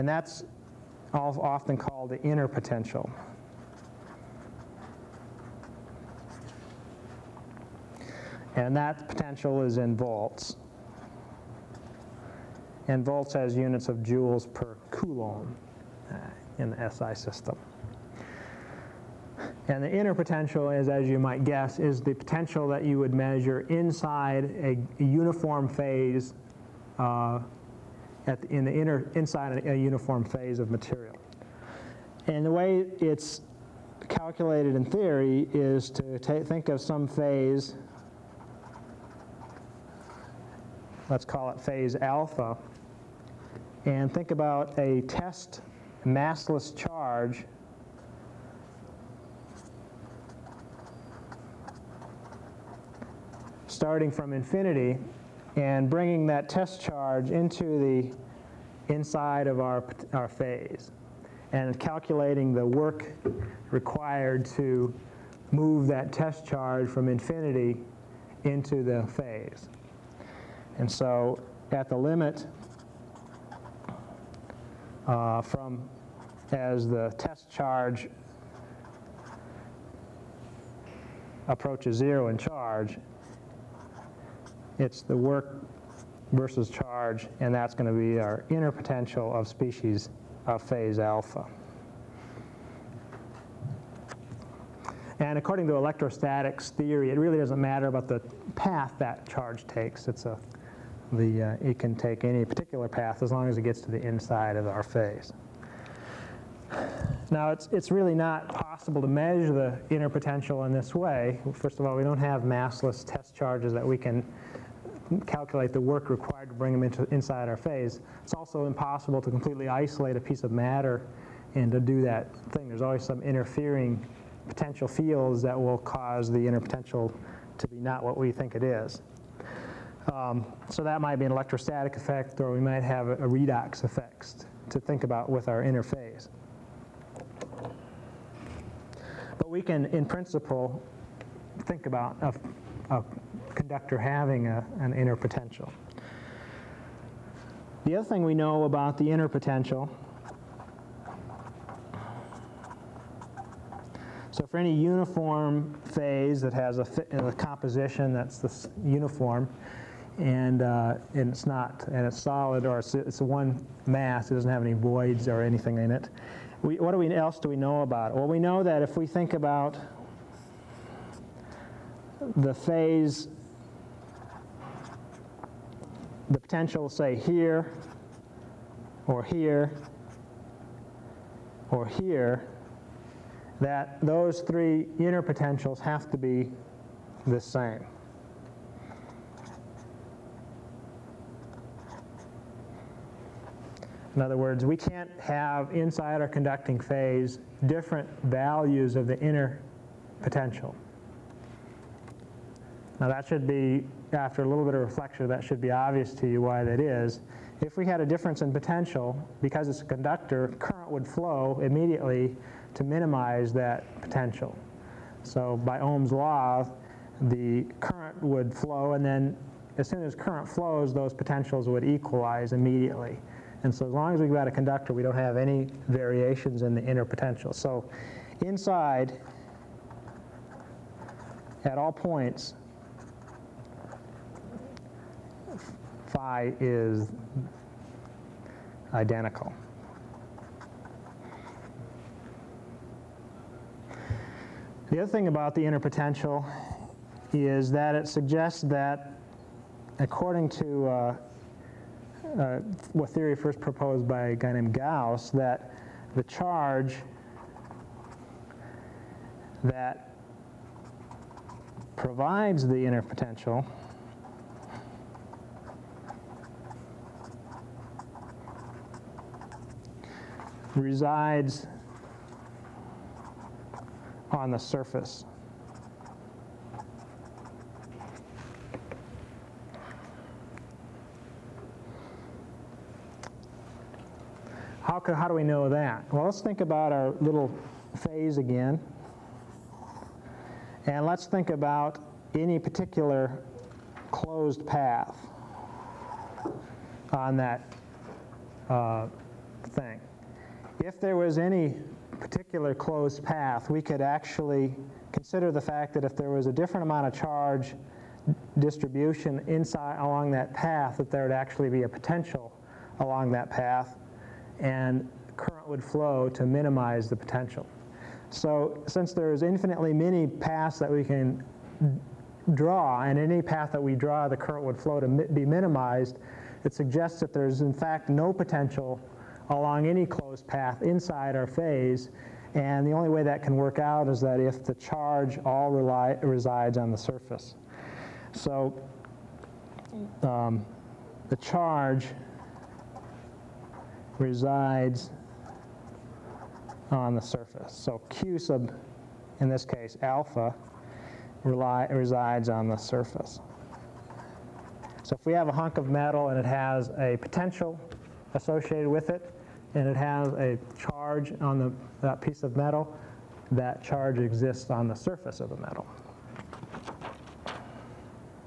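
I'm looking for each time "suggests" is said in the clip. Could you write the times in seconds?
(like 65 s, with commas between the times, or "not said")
248 s, 326 s.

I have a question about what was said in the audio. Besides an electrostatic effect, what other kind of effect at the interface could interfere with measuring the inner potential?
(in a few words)
redox effect.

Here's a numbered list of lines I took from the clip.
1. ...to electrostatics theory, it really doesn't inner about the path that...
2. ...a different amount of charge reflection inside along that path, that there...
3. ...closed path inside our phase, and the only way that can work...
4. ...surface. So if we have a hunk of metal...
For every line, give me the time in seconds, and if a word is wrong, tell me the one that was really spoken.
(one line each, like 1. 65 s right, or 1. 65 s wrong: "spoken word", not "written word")
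1. 95 s wrong: "matter", not "inner"
2. 306 s wrong: "distribution", not "reflection"
3. 330 s right
4. 352 s right.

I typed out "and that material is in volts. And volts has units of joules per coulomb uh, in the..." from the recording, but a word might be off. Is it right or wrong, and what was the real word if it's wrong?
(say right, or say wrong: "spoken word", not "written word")
wrong: "potential", not "material".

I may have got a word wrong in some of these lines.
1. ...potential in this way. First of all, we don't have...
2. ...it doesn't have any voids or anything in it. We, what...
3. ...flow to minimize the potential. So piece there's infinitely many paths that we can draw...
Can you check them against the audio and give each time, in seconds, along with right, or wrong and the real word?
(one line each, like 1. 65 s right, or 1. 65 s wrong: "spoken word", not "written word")
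1. 110 s right
2. 164 s right
3. 315 s wrong: "since", not "piece".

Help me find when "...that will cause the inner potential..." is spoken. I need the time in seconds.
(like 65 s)
125 s.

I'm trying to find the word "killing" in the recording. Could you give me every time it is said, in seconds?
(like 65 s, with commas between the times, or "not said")
not said.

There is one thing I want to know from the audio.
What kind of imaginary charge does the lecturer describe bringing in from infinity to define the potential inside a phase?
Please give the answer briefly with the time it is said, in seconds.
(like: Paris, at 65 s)
test massless charge, at 45 s.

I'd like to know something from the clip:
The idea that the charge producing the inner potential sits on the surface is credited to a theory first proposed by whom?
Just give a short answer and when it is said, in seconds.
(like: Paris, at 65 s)
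Gauss, at 254 s.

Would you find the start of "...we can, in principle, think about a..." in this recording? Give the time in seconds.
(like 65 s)
139 s.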